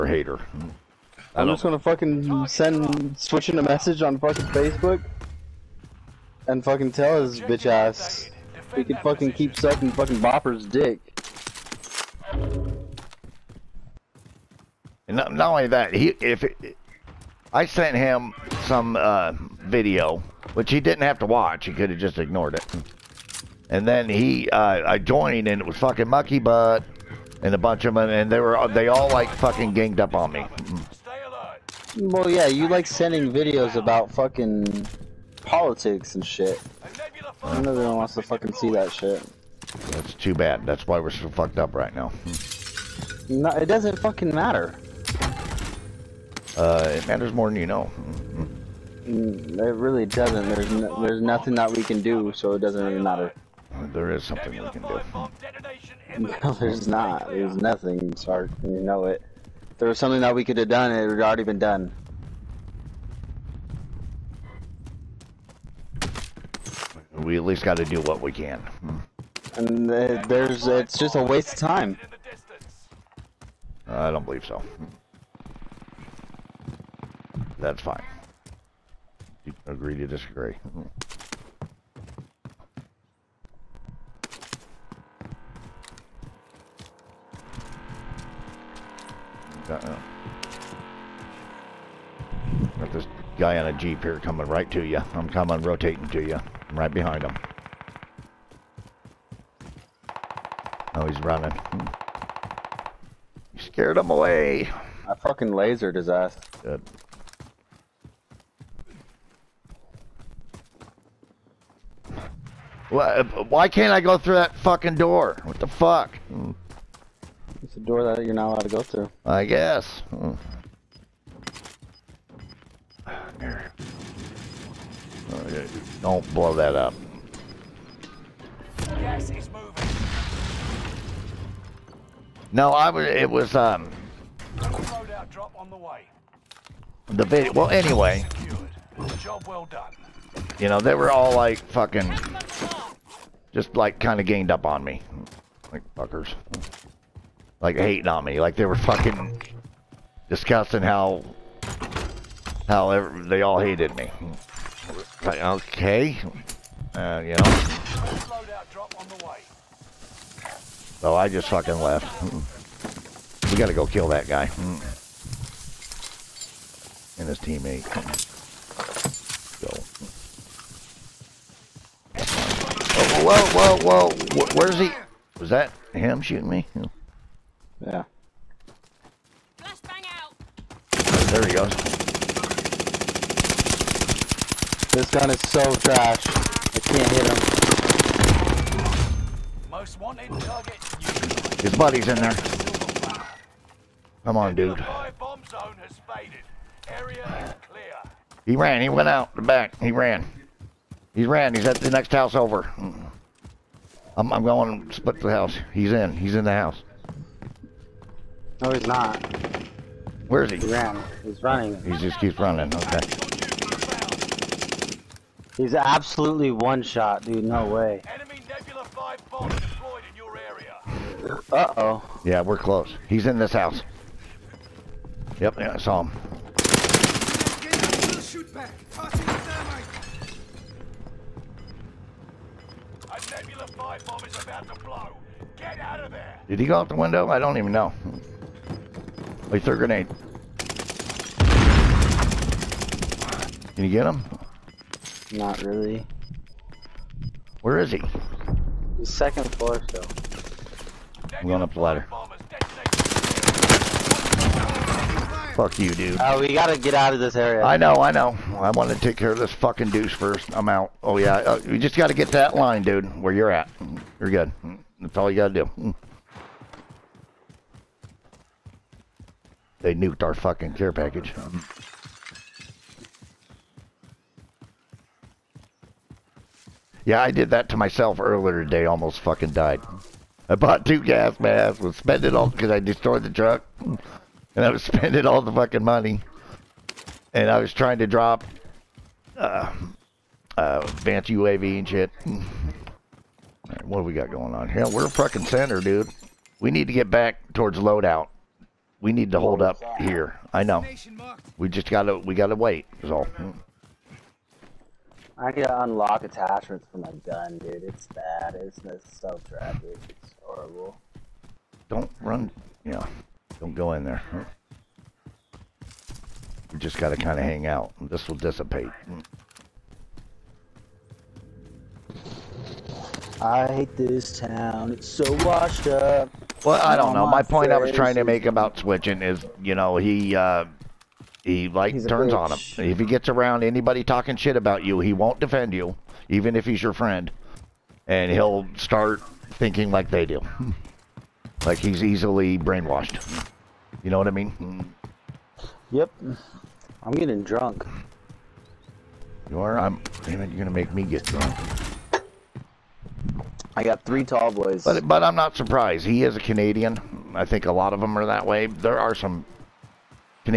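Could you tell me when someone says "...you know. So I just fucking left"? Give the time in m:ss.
2:37.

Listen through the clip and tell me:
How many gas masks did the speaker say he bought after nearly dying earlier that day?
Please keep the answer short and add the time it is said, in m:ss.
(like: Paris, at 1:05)
2, at 4:40.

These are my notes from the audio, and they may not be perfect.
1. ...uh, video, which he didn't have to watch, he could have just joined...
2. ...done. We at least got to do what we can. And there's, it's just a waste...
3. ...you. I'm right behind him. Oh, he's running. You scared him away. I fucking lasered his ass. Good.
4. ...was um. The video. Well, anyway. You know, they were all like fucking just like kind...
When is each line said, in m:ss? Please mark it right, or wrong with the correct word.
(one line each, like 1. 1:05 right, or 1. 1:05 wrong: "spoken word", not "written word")
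1. 0:18 wrong: "ignored", not "joined"
2. 1:01 right
3. 1:36 right
4. 2:13 right.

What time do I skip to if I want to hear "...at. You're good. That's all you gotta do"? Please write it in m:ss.
4:23.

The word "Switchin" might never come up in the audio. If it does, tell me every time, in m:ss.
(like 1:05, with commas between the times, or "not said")
0:03, 5:28.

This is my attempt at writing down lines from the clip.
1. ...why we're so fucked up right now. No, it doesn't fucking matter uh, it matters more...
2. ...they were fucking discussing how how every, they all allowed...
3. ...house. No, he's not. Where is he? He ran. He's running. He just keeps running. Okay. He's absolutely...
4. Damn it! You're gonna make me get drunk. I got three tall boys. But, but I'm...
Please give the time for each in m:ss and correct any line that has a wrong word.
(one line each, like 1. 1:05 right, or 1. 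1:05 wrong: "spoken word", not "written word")
1. 0:40 right
2. 2:28 wrong: "hated", not "allowed"
3. 3:26 right
4. 5:50 right.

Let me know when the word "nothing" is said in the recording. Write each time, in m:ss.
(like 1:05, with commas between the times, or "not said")
0:51, 0:57.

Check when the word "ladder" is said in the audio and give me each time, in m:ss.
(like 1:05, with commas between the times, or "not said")
4:11.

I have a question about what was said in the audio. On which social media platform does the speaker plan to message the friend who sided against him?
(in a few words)
Facebook.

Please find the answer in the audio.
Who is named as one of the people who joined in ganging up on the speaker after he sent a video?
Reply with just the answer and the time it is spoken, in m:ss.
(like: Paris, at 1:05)
Mucky Butt, at 0:26.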